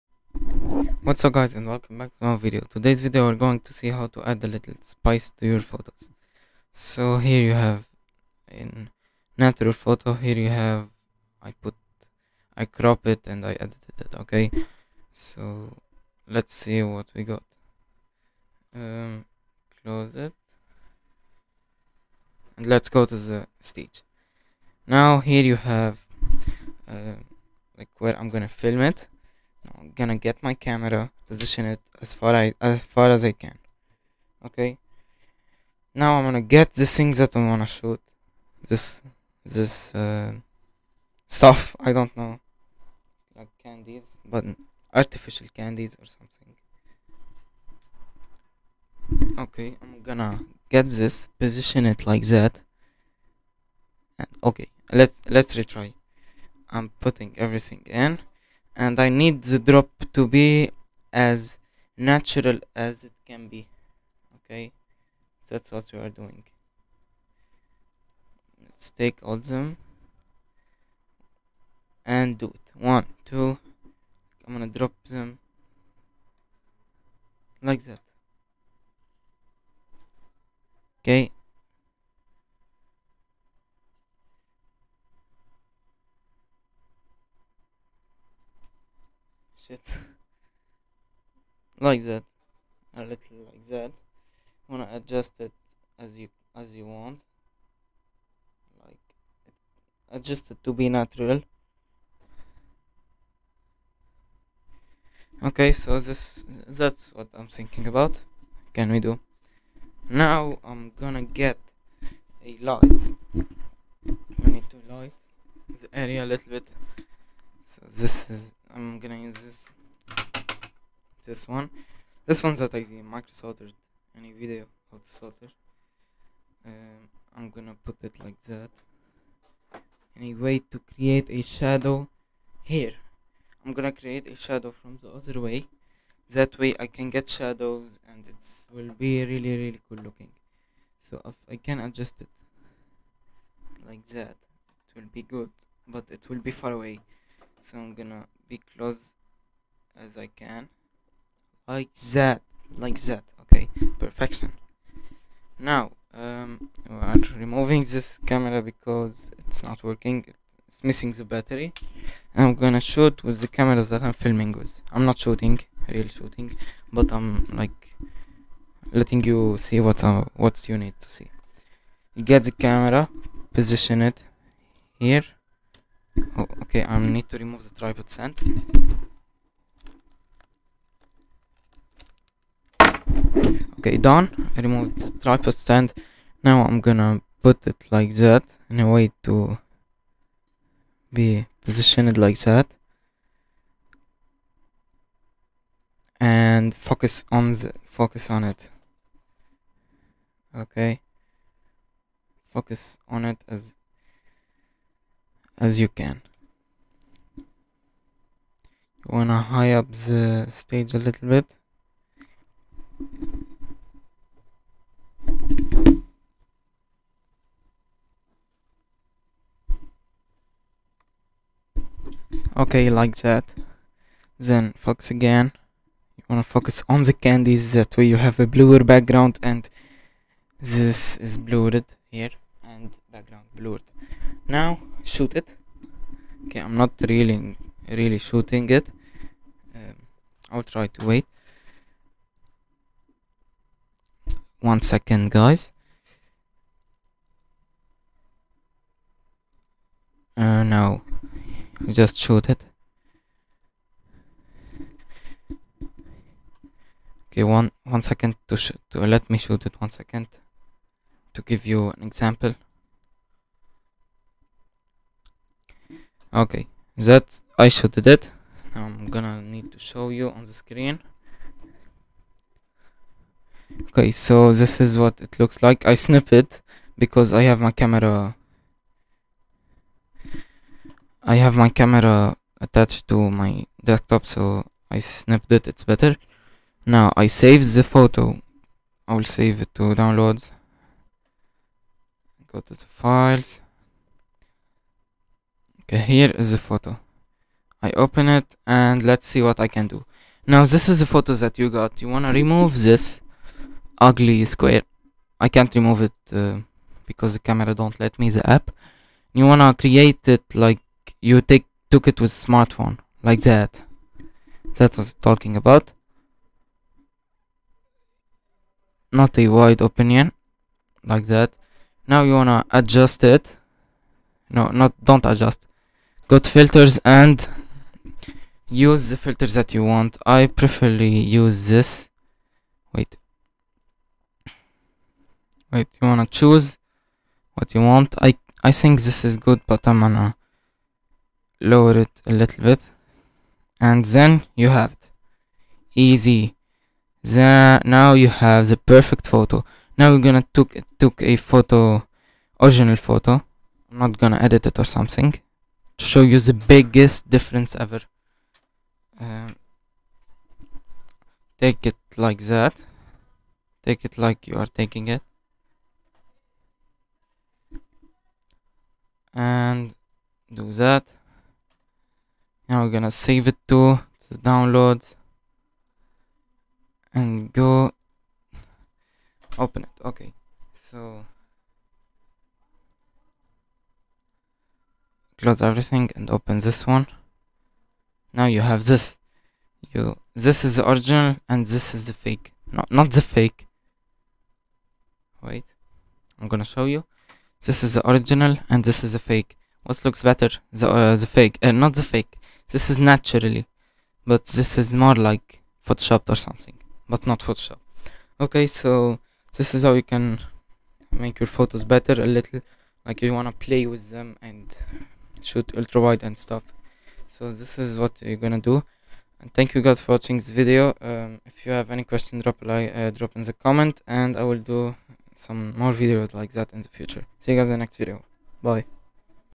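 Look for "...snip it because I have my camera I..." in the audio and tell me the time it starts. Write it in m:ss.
4:35.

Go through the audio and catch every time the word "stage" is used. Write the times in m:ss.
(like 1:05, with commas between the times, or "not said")
0:23, 3:30.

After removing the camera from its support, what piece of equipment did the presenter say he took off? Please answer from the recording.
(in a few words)
tripod stand.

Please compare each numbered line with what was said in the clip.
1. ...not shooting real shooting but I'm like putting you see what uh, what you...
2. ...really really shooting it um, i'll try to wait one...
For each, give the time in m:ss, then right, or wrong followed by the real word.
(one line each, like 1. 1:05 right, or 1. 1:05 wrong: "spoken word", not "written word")
1. 2:45 wrong: "letting", not "putting"
2. 3:57 right.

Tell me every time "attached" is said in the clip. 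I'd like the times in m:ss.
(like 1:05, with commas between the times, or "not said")
4:42.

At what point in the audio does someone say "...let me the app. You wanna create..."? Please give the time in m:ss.
5:07.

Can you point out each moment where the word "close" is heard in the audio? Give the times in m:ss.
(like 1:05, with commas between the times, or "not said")
0:19, 2:28, 6:25.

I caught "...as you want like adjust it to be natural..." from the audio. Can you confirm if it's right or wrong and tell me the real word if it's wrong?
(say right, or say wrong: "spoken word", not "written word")
right.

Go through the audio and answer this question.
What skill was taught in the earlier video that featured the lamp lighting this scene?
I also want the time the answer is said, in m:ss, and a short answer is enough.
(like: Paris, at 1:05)
how to solder, at 2:04.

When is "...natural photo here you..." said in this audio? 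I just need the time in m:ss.
0:09.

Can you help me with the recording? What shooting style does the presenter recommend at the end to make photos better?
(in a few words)
ultra wide.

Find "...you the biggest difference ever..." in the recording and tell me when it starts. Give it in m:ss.
5:56.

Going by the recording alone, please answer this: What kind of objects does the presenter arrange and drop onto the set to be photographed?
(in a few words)
artificial candies.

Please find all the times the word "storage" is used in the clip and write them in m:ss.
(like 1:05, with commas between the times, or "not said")
not said.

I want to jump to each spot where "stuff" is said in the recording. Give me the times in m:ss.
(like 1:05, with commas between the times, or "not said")
0:41, 6:56.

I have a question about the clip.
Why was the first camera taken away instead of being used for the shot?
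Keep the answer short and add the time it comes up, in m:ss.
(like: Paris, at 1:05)
missing the battery, at 2:40.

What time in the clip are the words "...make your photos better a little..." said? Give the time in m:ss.
6:51.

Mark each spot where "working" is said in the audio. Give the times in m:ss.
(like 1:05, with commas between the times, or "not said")
2:39.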